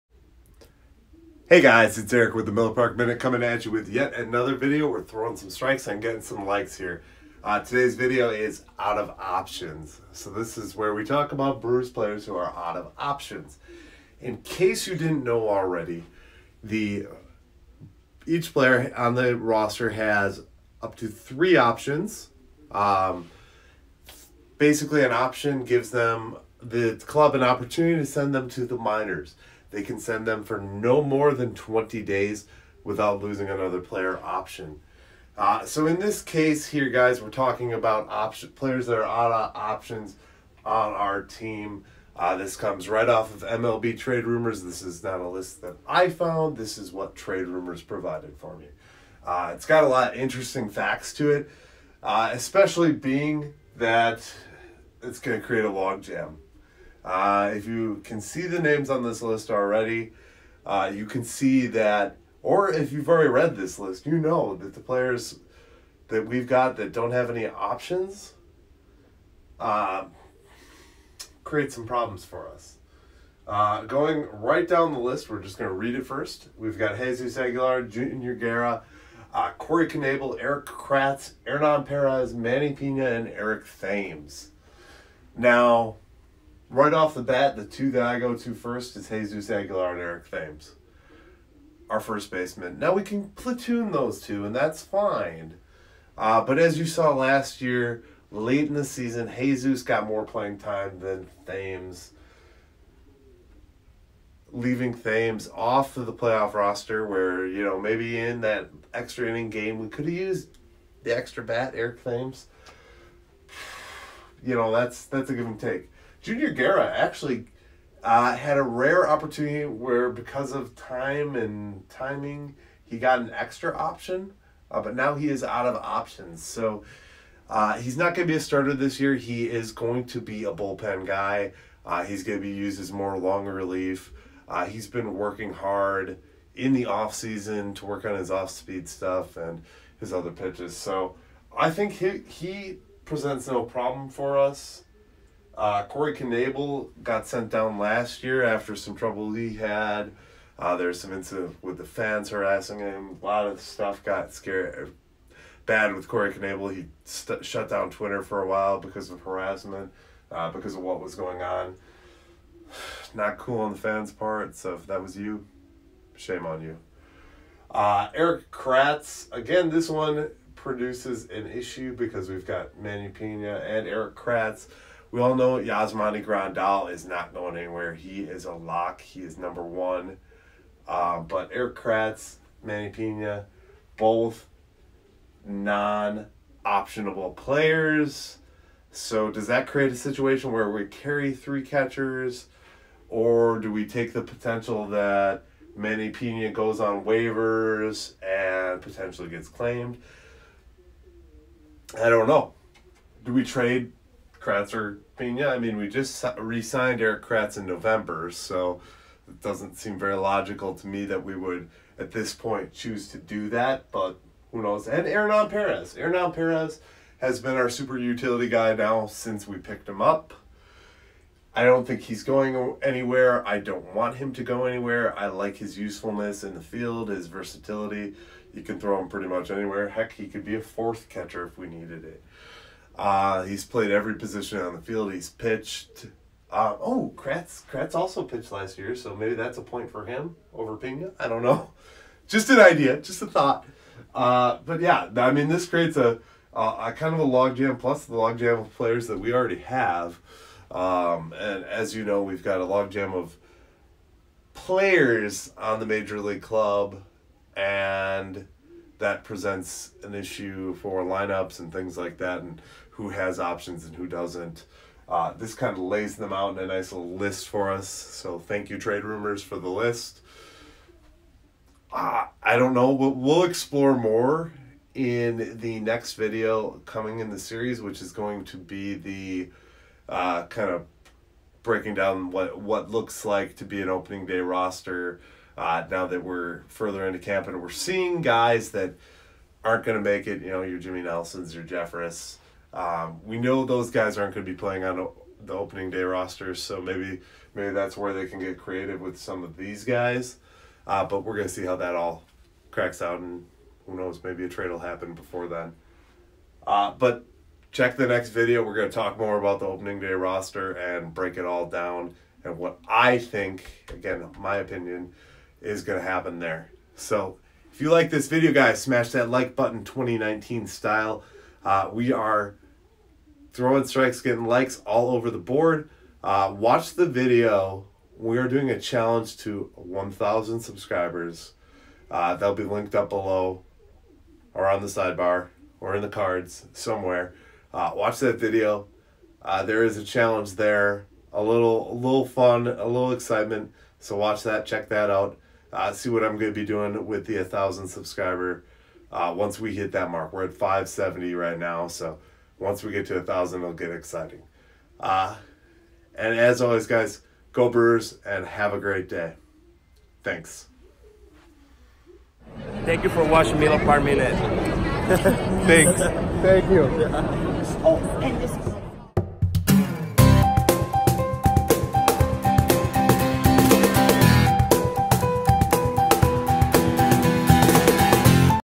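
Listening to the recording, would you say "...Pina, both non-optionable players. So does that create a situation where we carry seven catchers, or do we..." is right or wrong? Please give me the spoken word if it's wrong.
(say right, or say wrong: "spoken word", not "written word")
wrong: "three", not "seven".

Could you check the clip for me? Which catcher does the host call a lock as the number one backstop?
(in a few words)
Yasmani Grandal.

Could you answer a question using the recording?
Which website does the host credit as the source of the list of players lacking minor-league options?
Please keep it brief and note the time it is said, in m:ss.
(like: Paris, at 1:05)
MLB Trade Rumors, at 0:43.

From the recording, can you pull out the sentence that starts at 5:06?
Uh, but check the next video.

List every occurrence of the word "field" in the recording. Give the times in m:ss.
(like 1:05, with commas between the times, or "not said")
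3:46, 3:54.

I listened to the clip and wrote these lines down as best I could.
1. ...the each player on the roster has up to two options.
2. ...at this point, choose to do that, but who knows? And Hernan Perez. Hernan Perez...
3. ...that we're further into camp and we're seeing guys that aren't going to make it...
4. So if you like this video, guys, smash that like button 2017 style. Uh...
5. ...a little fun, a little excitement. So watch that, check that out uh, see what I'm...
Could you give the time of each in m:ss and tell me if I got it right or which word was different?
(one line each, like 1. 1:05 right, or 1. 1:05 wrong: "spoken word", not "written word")
1. 0:16 wrong: "three", not "two"
2. 3:31 right
3. 4:46 right
4. 5:16 wrong: "2019", not "2017"
5. 5:41 right.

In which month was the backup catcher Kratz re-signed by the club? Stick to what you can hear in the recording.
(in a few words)
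November.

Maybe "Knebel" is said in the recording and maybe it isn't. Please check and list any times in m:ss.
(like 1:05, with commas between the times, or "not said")
1:19, 2:26, 2:36.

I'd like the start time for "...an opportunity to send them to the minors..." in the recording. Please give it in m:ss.
0:27.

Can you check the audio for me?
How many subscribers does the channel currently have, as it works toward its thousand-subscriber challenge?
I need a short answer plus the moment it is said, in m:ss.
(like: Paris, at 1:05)
570, at 5:50.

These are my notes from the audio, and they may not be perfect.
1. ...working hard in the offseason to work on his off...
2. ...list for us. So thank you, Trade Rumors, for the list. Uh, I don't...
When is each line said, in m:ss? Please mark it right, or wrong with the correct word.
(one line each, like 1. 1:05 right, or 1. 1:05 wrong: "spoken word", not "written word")
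1. 2:15 right
2. 4:27 right.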